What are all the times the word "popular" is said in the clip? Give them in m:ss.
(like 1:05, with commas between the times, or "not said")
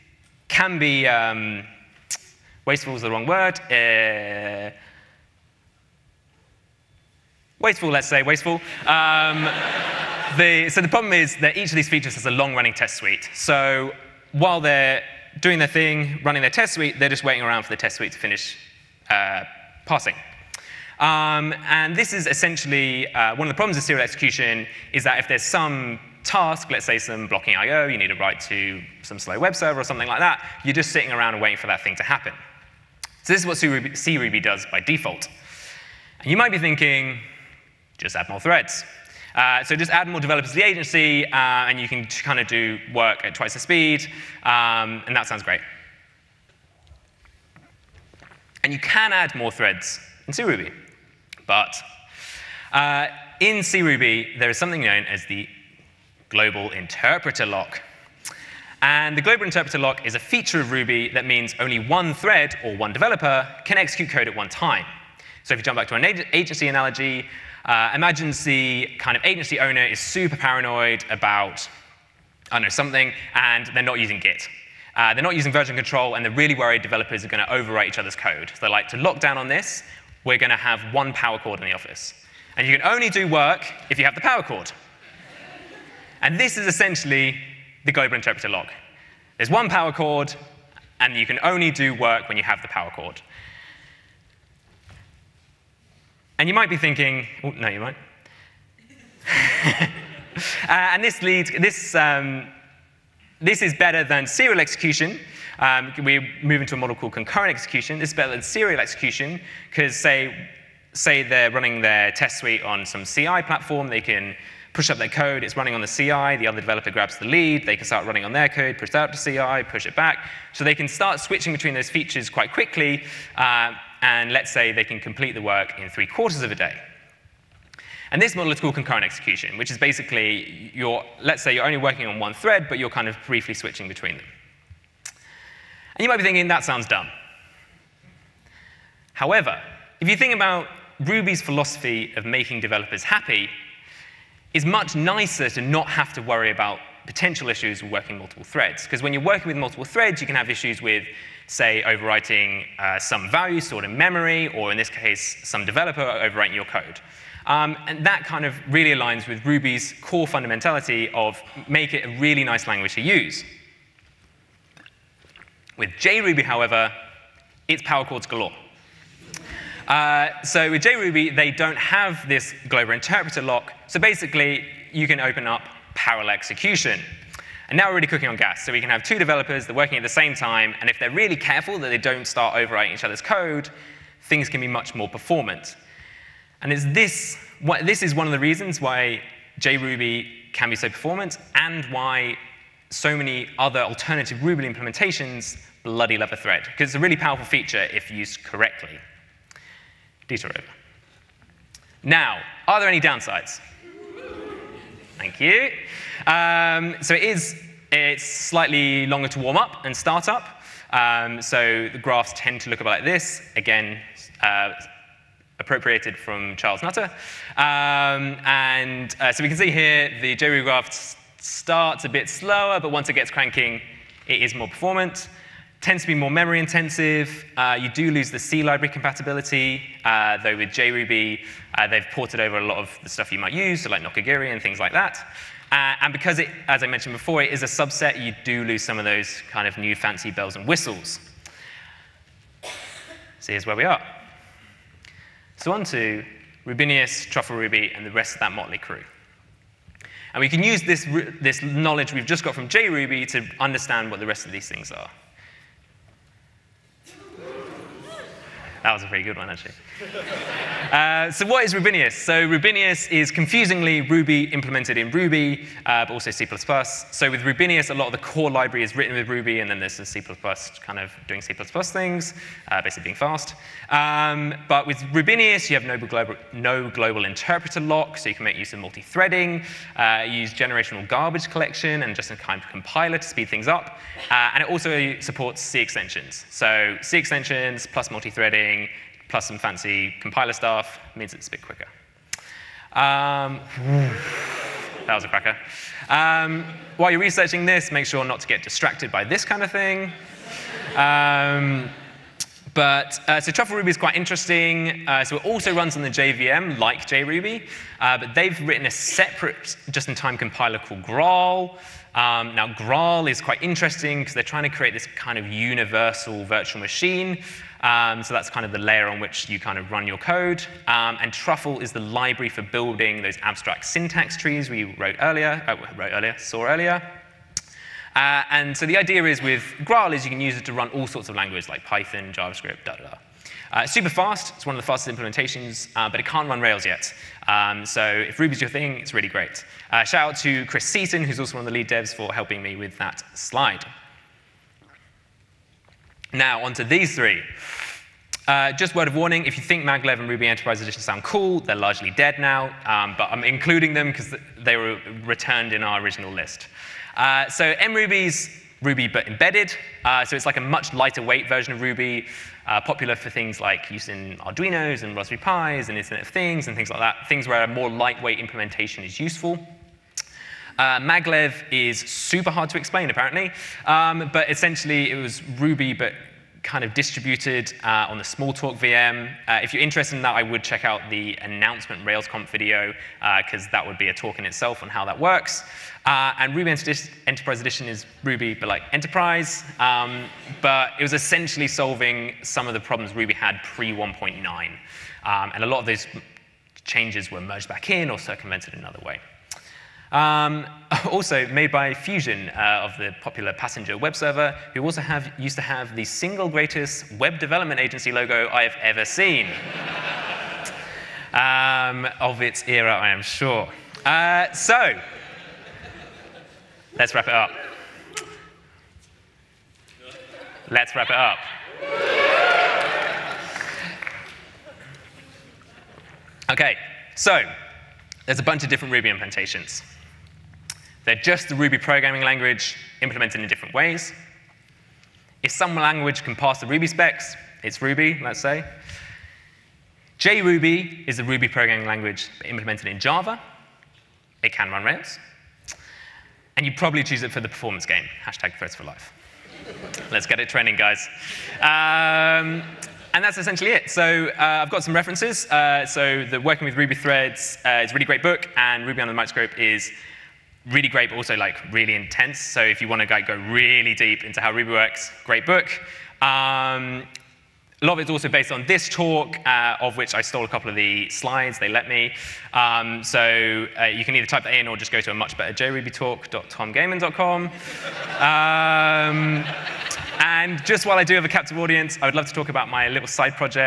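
6:02, 6:43.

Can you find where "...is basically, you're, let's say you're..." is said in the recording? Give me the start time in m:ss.
2:09.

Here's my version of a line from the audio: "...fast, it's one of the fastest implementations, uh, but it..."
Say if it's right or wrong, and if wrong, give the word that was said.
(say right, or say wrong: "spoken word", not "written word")
right.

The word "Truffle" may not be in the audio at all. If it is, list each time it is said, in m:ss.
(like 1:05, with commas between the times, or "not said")
4:07, 5:03, 5:21.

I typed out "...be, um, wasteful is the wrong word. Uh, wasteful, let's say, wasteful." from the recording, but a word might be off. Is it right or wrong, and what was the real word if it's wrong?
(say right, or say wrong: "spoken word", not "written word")
right.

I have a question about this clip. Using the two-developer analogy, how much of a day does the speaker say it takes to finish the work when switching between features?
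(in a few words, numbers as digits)
three quarters of a day.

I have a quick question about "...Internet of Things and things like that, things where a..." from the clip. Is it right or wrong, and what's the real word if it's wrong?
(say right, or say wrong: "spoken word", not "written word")
right.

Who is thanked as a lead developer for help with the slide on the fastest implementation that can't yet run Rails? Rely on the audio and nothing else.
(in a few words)
Chris Seaton.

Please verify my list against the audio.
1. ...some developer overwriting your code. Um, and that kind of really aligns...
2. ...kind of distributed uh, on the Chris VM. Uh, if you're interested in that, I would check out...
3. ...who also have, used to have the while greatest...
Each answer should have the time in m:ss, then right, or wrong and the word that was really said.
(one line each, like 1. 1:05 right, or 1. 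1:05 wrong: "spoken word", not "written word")
1. 2:35 right
2. 6:16 wrong: "Smalltalk", not "Chris"
3. 6:44 wrong: "single", not "while".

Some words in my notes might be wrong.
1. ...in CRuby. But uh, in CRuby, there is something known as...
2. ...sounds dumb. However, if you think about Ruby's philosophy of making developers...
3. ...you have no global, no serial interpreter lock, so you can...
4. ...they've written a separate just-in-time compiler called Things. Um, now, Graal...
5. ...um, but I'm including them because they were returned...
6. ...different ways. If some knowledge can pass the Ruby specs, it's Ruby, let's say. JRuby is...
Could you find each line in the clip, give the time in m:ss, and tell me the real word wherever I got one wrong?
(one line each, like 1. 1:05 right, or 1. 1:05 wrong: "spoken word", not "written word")
1. 0:50 right
2. 2:16 right
3. 4:35 wrong: "global", not "serial"
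4. 5:08 wrong: "Graal", not "Things"
5. 5:52 right
6. 7:13 wrong: "language", not "knowledge".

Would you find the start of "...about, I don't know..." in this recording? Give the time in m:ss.
1:11.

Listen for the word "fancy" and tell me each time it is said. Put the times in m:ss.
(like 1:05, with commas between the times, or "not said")
3:59, 4:49.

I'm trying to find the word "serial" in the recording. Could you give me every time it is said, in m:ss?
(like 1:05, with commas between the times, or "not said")
0:23, 1:44, 1:48.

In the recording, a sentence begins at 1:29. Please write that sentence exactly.
There's one power cord, and you can only do work when you have the power cord.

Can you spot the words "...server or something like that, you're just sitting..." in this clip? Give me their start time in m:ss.
0:29.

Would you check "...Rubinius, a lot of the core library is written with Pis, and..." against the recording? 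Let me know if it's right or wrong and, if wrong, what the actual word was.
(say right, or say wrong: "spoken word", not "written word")
wrong: "Ruby", not "Pis".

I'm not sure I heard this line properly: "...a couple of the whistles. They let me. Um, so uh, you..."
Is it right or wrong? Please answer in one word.
wrong.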